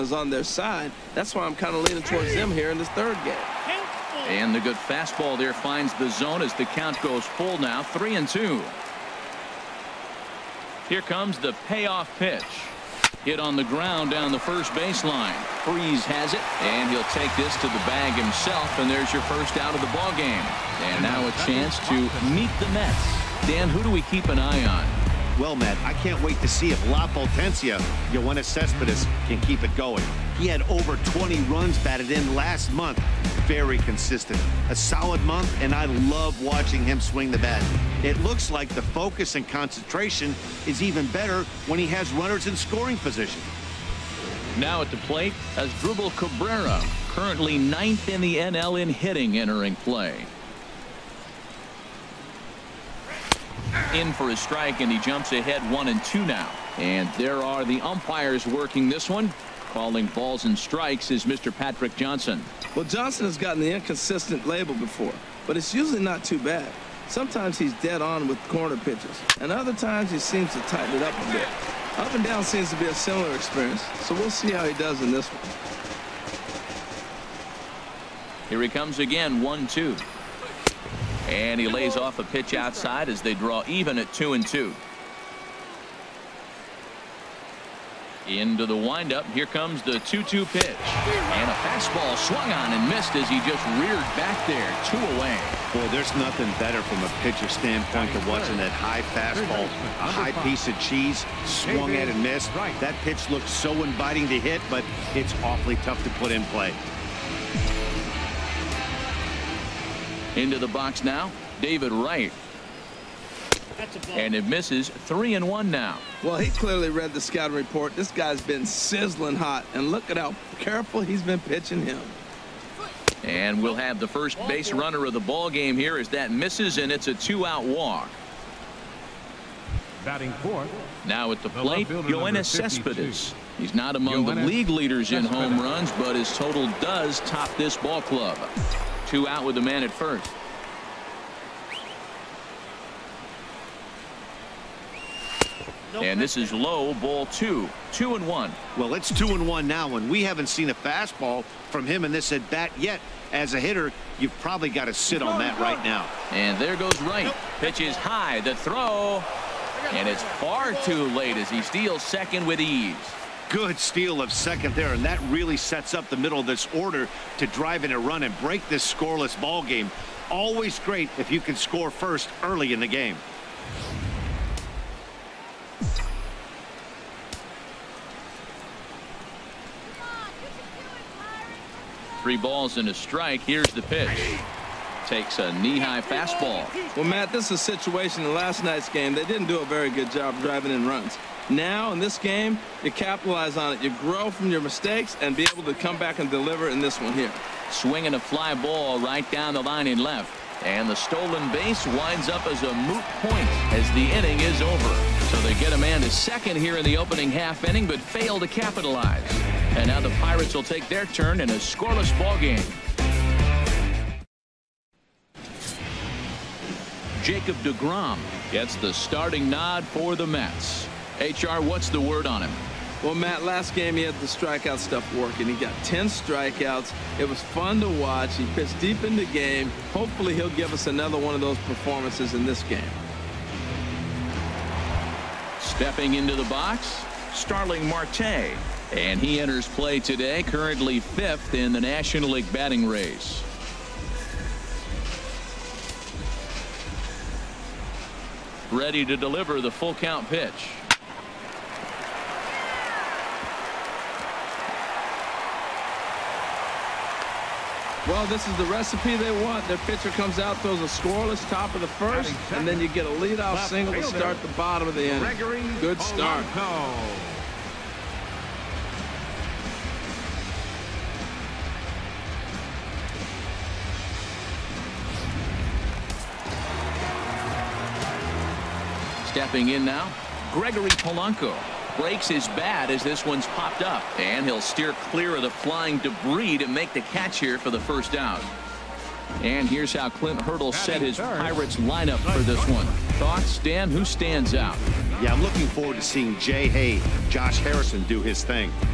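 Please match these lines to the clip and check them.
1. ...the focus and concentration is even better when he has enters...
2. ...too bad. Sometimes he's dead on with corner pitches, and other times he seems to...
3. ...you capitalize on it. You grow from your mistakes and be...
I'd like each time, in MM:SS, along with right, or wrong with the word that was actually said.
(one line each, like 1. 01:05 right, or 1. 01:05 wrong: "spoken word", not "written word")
1. 00:38 wrong: "runners", not "enters"
2. 01:06 right
3. 03:12 right.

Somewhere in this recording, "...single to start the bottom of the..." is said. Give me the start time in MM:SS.
04:23.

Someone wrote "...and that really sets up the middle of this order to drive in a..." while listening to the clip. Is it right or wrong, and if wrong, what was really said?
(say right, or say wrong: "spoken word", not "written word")
right.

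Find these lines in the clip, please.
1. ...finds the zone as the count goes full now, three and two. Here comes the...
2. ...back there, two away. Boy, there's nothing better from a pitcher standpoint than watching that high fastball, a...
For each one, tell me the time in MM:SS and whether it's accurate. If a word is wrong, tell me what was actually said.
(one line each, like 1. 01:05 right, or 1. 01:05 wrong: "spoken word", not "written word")
1. 00:05 right
2. 01:34 right.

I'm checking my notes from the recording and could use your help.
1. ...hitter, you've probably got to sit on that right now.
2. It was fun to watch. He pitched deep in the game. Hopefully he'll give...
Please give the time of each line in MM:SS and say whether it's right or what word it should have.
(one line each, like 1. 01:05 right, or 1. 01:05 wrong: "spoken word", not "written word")
1. 02:33 right
2. 03:47 right.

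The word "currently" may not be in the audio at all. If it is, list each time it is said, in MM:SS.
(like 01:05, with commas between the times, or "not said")
00:47, 04:00.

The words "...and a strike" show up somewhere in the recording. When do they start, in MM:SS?
03:02.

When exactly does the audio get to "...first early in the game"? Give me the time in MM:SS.
02:51.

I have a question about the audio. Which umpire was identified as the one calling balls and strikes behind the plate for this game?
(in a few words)
Patrick Johnson.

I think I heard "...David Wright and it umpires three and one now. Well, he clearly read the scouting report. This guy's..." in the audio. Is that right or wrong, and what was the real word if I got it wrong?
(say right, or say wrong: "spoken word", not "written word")
wrong: "misses", not "umpires".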